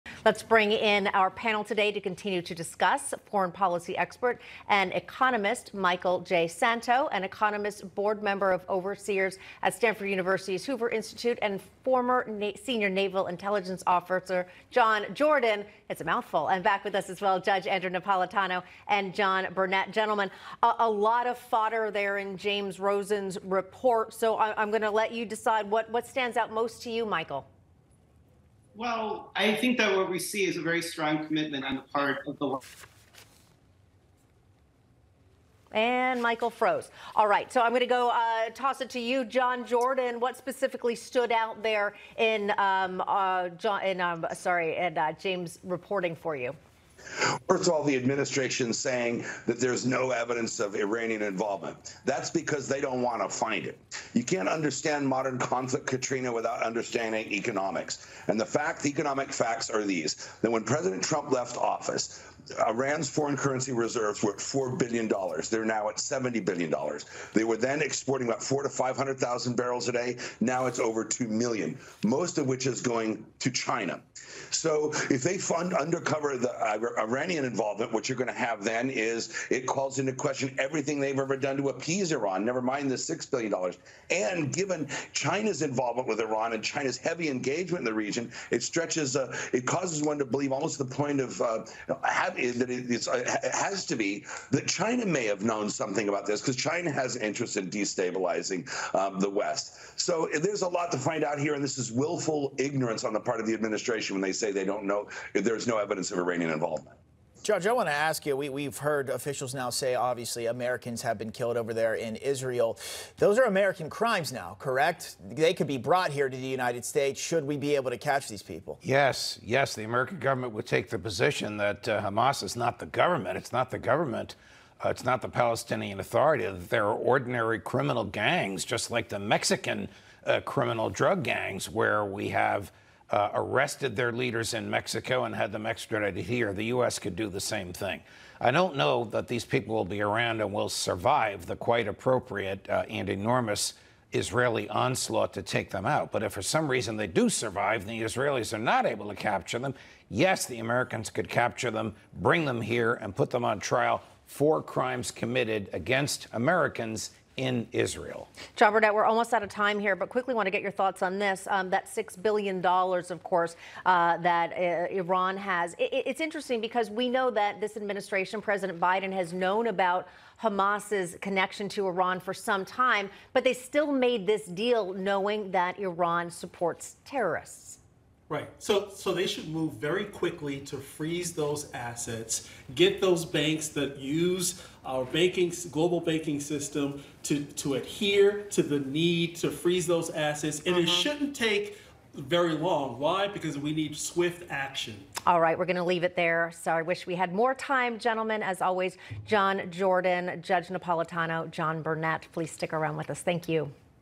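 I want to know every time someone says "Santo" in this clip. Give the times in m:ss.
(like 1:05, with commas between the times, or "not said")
0:06.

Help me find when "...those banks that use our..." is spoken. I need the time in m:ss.
3:03.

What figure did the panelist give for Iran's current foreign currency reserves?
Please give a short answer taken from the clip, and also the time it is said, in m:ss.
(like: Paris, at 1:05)
$70 billion, at 1:05.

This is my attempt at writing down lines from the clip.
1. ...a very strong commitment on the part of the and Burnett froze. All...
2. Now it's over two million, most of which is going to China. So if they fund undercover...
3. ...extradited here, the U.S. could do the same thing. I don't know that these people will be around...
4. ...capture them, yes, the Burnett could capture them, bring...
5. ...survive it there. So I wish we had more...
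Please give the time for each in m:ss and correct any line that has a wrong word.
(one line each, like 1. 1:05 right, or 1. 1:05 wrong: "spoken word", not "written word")
1. 0:30 wrong: "Michael", not "Burnett"
2. 1:10 right
3. 2:15 right
4. 2:29 wrong: "Americans", not "Burnett"
5. 3:15 wrong: "leave", not "survive".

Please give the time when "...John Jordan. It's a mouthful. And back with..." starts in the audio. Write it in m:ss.
0:14.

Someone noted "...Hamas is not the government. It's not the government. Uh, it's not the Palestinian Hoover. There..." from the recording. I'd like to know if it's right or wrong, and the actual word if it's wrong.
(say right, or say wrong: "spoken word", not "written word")
wrong: "Authority", not "Hoover".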